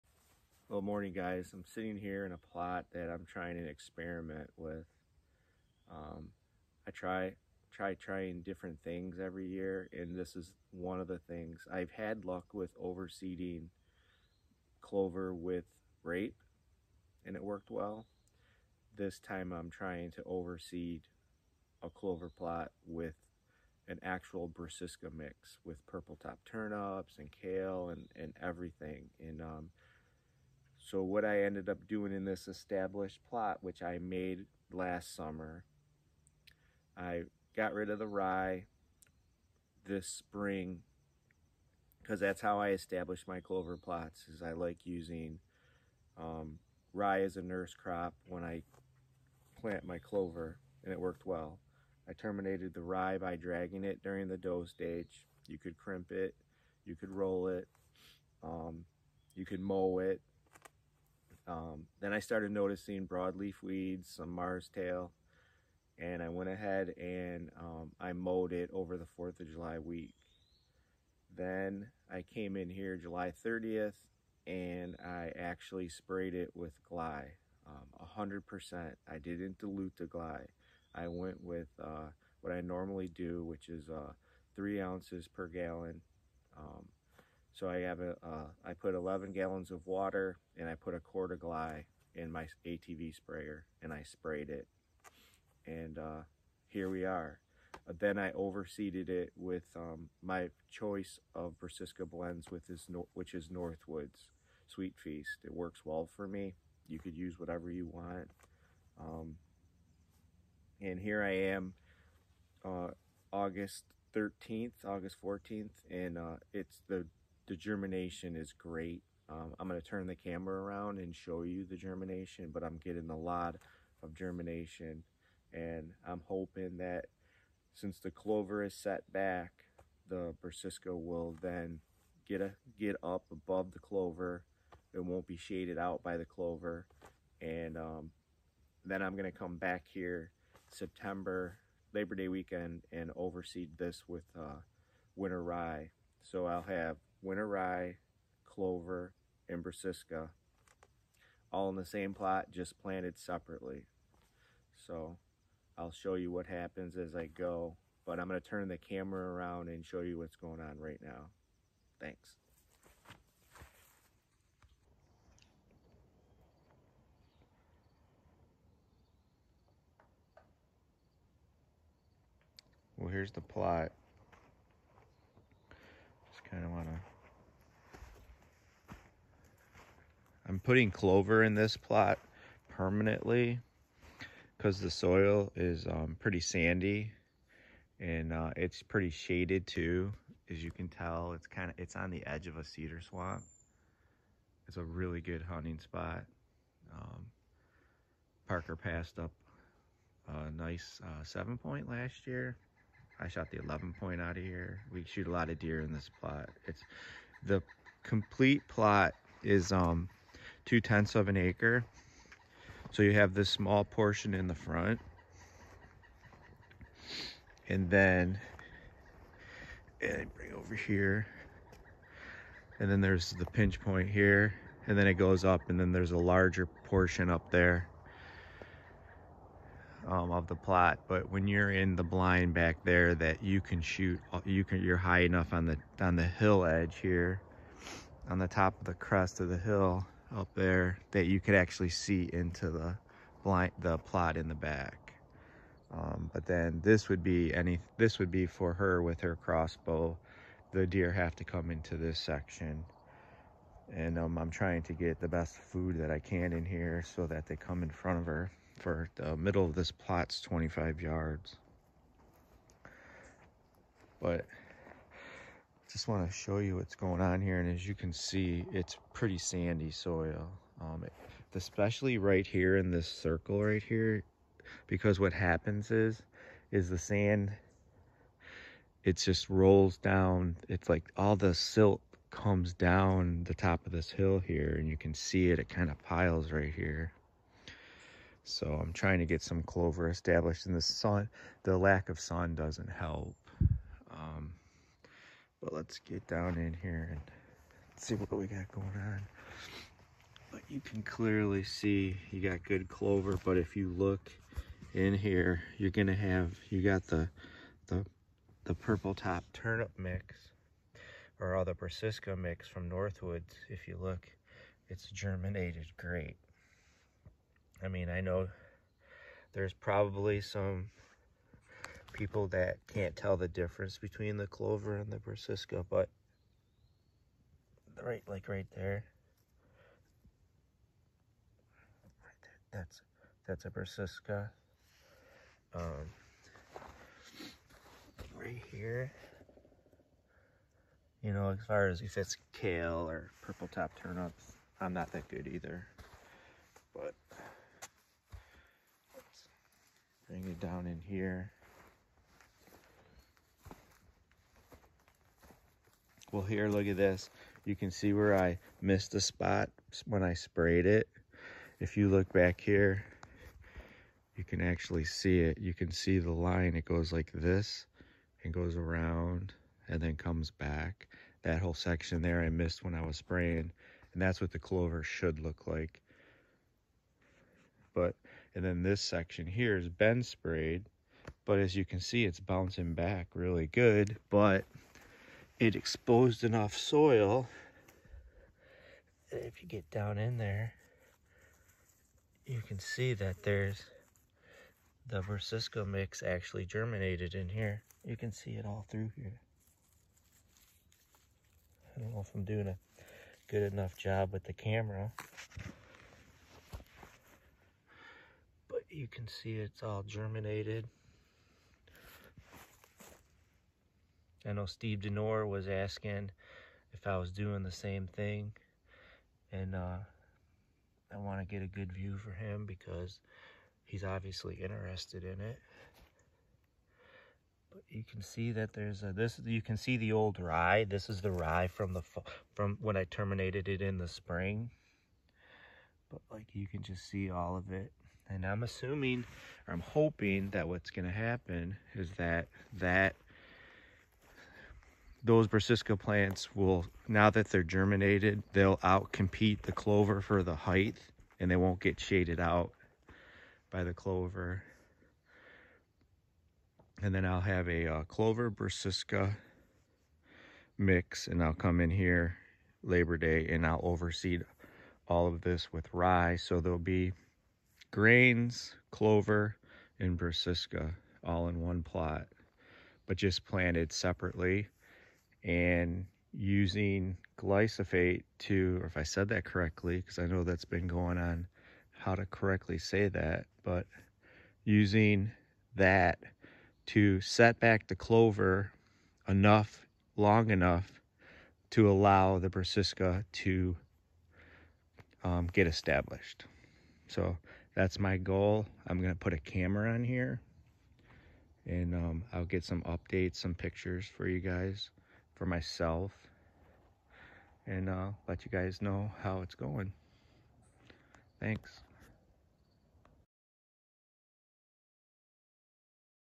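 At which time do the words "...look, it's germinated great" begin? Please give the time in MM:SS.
05:14.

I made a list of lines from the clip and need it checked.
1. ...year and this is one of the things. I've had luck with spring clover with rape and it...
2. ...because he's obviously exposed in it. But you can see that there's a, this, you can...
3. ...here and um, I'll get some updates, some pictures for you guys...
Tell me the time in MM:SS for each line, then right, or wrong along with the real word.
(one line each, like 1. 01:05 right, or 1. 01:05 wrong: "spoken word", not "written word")
1. 00:09 wrong: "overseeding", not "spring"
2. 07:02 wrong: "interested", not "exposed"
3. 08:20 right.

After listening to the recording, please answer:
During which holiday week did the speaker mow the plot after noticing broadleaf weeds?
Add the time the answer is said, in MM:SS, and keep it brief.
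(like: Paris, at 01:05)
4th of July, at 01:09.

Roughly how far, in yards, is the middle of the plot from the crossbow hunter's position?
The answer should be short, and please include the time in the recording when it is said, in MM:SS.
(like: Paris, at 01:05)
25 yards, at 04:20.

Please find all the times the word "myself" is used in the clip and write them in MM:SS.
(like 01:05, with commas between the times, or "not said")
08:25.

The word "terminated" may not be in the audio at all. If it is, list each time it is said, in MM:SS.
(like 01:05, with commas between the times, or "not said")
00:52, 07:13.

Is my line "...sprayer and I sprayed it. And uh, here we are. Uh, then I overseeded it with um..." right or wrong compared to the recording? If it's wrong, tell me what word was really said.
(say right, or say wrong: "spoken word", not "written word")
right.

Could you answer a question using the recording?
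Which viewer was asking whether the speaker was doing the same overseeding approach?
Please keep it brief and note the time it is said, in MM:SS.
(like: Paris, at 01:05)
Steve Denore, at 06:54.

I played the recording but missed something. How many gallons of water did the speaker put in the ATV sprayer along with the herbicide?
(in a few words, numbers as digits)
11.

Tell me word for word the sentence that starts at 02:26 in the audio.
So I'll have winter rye, clover, and brassica, all in the same plot, just planted separately.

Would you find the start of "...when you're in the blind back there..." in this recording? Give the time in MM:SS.
03:51.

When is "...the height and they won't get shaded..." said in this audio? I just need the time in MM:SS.
07:30.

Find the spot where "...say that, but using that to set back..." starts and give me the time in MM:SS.
08:02.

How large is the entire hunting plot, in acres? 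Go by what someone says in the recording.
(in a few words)
0.2 acre.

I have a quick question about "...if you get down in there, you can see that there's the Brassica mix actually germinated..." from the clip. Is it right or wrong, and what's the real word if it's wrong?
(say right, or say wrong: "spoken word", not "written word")
right.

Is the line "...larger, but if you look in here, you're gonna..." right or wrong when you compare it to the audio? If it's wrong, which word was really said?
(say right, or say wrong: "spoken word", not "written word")
wrong: "clover", not "larger".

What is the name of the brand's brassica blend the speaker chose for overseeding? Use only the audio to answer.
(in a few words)
Sweet Feast.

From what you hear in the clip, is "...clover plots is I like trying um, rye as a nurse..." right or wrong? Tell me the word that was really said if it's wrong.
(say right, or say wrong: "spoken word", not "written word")
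wrong: "using", not "trying".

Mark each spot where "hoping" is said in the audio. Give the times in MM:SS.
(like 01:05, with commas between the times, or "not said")
02:06, 07:19.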